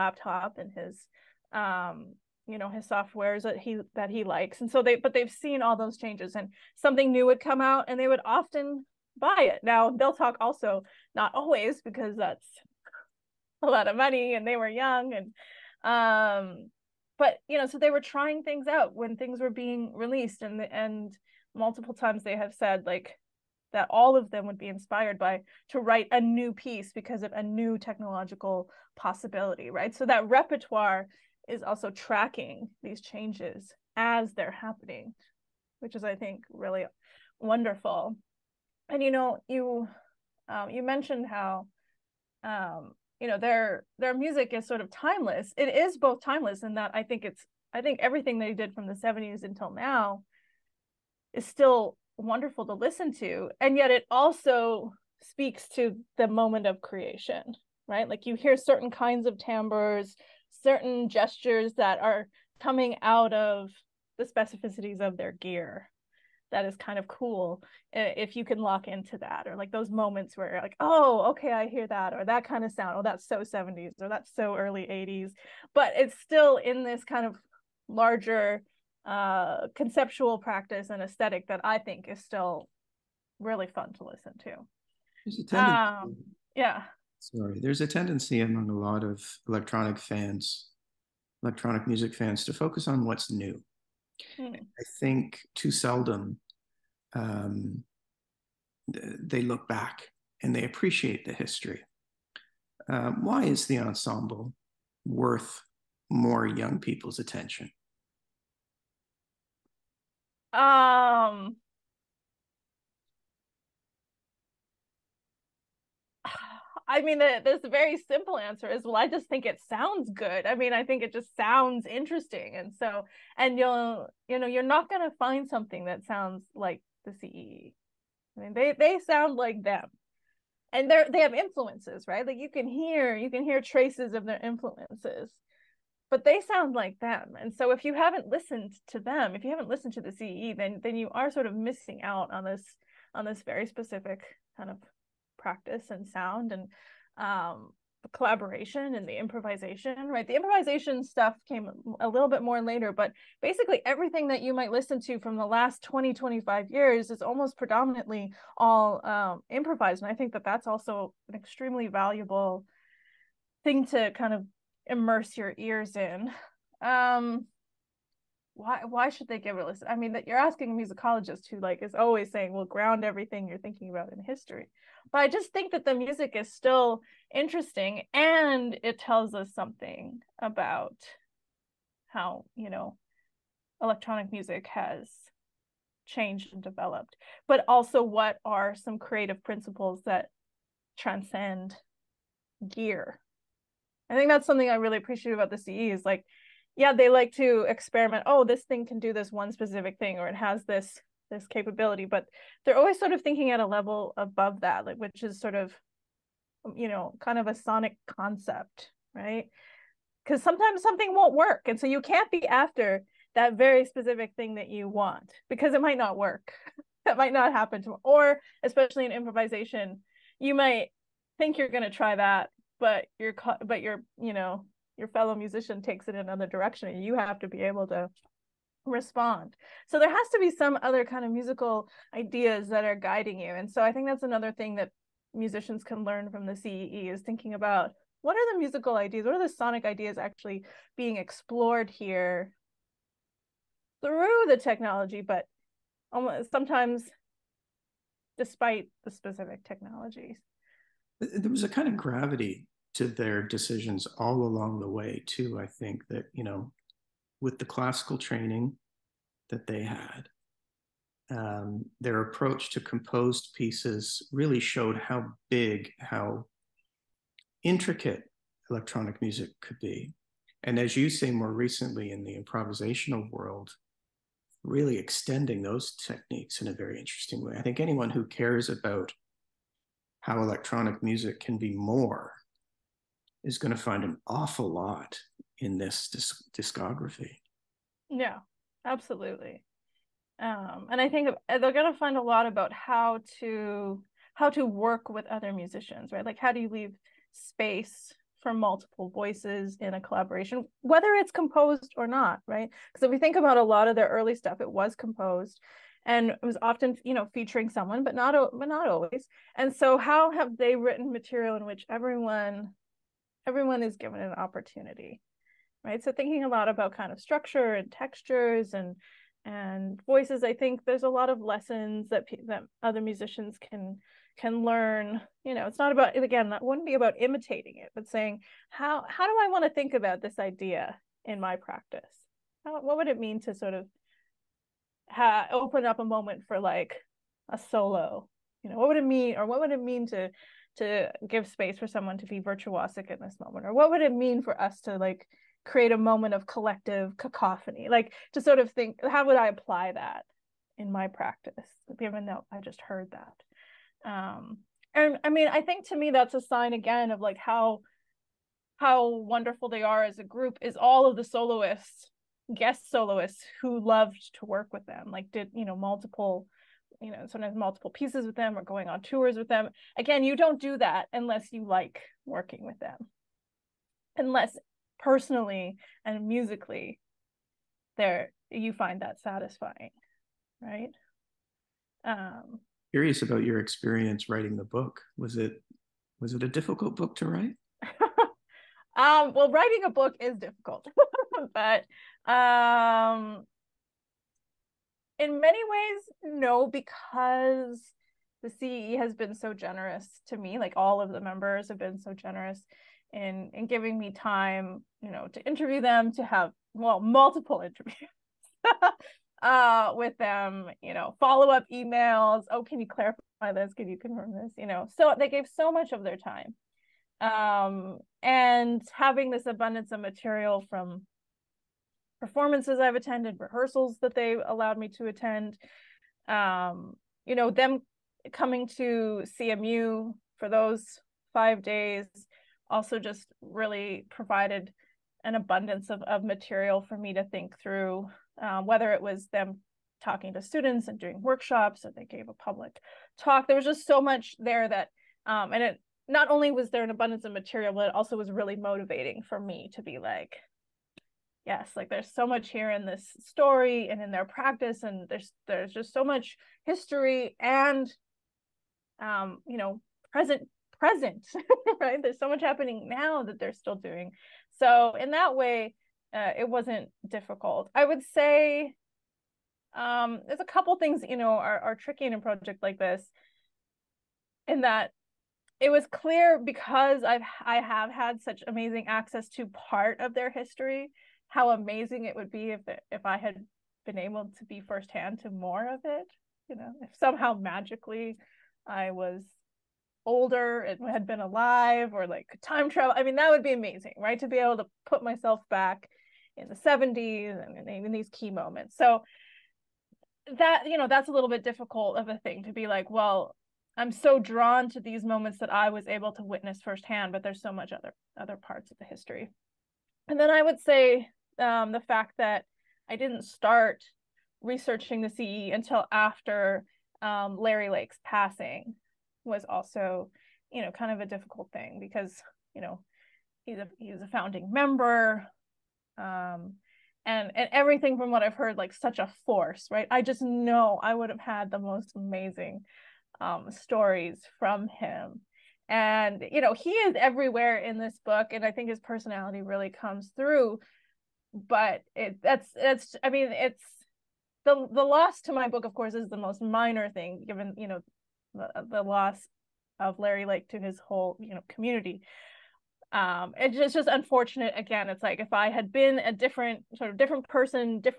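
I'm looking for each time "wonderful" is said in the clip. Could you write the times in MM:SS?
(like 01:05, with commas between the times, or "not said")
00:37, 00:52, 05:59.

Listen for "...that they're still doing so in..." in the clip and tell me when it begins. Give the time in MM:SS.
07:43.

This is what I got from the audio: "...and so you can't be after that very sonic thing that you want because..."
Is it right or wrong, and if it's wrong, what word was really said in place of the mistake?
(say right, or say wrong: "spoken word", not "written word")
wrong: "specific", not "sonic".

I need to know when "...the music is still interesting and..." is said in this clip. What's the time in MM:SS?
02:55.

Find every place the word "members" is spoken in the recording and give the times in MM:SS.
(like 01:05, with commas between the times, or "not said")
06:41, 08:44.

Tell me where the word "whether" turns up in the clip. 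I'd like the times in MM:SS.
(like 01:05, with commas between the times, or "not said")
05:00, 07:18.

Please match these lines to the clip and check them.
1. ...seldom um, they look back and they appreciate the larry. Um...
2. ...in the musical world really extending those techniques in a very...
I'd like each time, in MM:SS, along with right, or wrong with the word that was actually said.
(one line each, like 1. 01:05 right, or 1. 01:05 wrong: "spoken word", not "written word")
1. 01:35 wrong: "history", not "larry"
2. 04:32 wrong: "improvisational", not "musical".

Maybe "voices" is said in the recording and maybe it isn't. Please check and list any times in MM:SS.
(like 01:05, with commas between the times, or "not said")
04:59, 05:20.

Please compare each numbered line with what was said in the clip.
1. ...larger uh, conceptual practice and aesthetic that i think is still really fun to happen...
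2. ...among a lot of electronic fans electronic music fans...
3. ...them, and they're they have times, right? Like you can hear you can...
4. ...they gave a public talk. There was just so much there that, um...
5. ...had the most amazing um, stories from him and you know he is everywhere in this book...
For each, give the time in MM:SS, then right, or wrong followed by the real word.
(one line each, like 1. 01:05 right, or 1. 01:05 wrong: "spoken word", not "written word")
1. 01:17 wrong: "listen", not "happen"
2. 01:28 right
3. 02:09 wrong: "influences", not "times"
4. 07:21 right
5. 08:51 right.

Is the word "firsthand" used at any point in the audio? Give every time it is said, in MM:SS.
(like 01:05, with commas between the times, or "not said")
08:04, 08:26.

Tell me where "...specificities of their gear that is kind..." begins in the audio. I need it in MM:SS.
01:04.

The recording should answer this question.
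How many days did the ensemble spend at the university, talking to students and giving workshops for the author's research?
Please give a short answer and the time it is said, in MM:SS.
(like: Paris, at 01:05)
5, at 07:11.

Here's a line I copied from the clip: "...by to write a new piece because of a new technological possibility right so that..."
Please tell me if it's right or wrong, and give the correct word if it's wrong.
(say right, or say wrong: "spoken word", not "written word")
right.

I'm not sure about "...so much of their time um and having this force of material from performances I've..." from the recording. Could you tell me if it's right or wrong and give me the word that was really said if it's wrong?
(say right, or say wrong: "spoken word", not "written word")
wrong: "abundance", not "force".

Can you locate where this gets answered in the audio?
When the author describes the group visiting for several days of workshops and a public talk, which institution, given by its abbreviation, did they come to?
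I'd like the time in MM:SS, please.
07:09.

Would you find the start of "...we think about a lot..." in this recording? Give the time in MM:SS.
05:03.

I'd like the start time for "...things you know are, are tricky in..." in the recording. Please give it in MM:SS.
07:50.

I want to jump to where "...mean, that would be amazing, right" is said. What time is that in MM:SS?
08:13.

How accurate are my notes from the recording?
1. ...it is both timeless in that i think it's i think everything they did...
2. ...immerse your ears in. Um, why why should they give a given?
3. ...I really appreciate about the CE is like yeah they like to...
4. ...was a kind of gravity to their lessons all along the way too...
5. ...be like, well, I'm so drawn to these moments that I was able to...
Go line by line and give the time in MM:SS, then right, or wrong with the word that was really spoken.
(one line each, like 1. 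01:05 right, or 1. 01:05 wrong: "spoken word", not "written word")
1. 00:45 right
2. 02:44 wrong: "listen", not "given"
3. 03:14 right
4. 04:11 wrong: "decisions", not "lessons"
5. 08:22 right.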